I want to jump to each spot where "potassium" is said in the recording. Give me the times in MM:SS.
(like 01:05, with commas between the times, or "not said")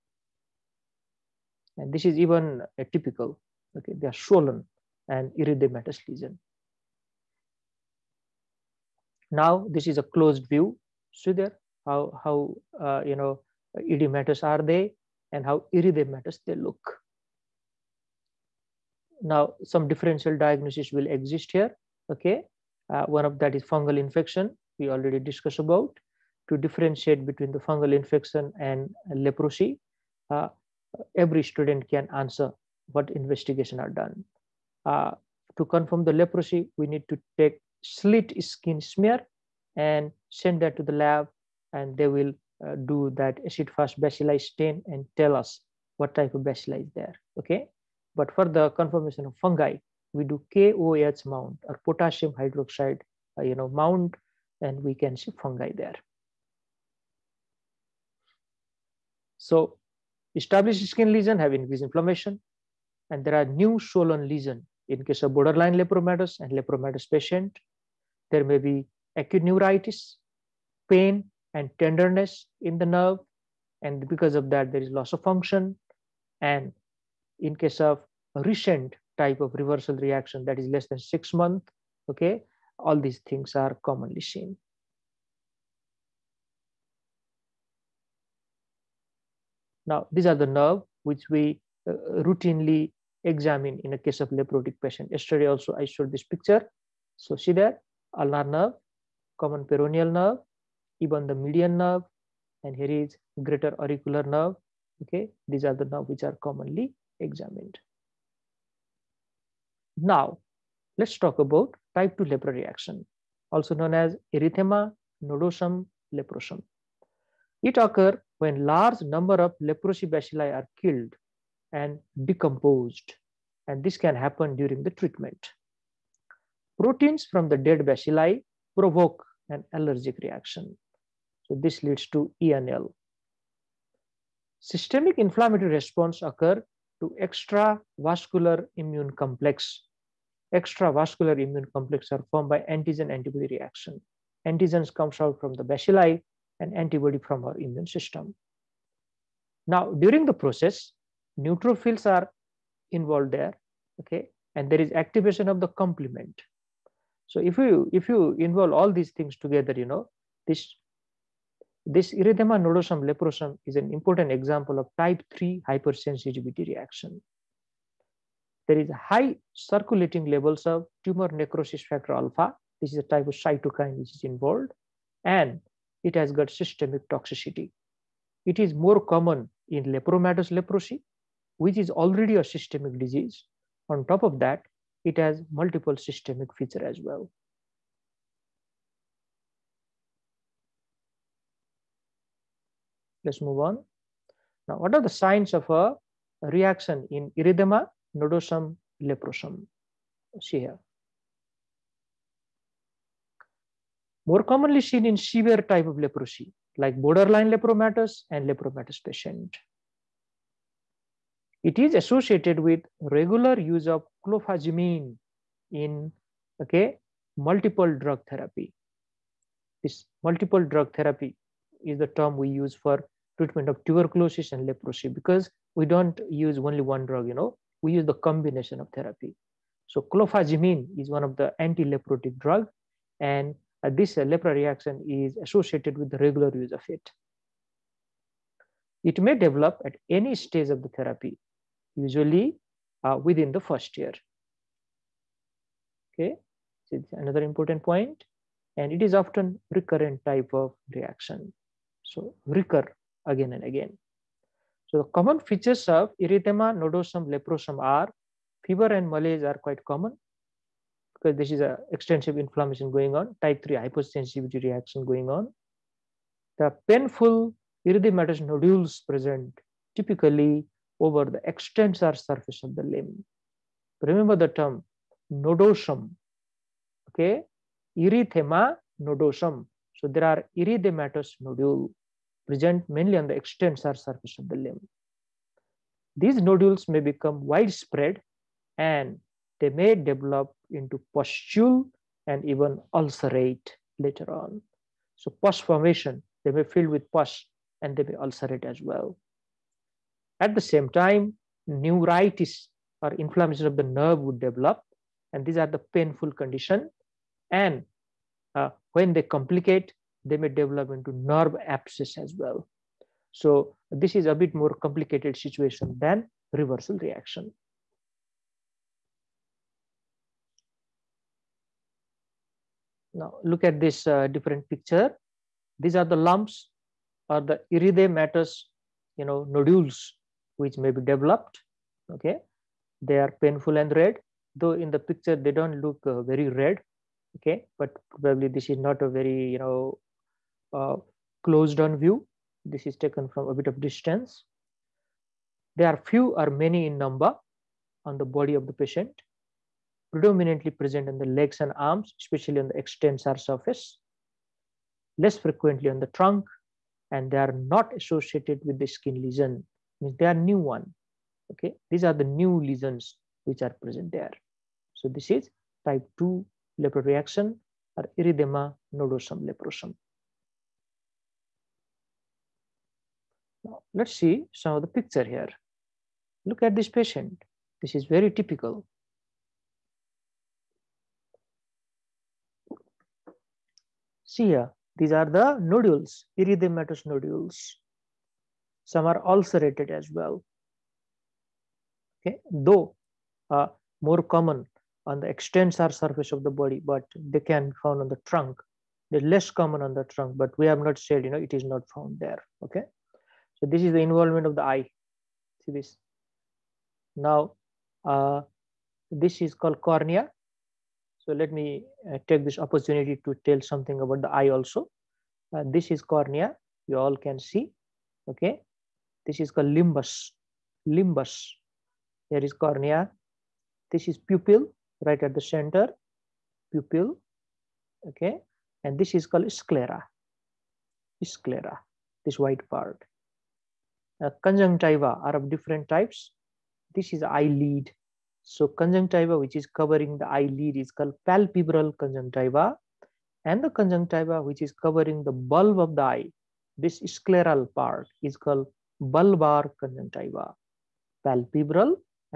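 00:51.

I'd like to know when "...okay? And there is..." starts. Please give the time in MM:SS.
02:34.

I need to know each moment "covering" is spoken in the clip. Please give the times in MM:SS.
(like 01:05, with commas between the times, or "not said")
07:19, 07:24.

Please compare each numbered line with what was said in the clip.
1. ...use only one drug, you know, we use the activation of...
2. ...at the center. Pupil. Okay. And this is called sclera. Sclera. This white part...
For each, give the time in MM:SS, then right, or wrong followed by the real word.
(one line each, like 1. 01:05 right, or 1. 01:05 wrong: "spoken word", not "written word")
1. 03:46 wrong: "combination", not "activation"
2. 07:05 right.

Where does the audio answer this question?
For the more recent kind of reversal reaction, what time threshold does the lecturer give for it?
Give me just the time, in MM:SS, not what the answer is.
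01:20.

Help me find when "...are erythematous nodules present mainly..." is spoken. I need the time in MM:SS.
04:40.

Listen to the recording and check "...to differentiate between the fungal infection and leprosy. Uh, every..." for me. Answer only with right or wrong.
right.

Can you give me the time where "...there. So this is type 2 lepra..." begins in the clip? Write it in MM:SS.
06:04.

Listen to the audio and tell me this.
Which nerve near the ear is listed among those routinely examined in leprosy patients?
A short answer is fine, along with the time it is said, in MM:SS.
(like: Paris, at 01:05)
greater auricular nerve, at 01:43.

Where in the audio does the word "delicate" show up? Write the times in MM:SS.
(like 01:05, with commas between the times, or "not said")
not said.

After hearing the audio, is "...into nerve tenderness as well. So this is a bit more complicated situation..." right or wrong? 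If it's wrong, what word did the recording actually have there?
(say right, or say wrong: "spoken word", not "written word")
wrong: "abscess", not "tenderness".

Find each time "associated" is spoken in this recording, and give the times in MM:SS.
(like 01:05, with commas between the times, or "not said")
03:31, 03:55, 05:57.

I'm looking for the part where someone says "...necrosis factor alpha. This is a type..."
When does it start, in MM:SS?
02:51.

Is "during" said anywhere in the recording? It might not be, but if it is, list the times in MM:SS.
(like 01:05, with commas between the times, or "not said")
02:04, 02:29.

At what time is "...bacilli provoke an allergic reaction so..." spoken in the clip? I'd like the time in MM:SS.
02:07.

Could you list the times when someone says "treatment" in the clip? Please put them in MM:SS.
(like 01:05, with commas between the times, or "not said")
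02:05, 03:43.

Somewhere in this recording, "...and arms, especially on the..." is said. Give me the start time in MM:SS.
05:51.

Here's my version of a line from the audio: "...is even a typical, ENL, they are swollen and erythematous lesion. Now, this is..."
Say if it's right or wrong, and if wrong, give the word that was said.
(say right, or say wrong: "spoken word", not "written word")
wrong: "Okay", not "ENL".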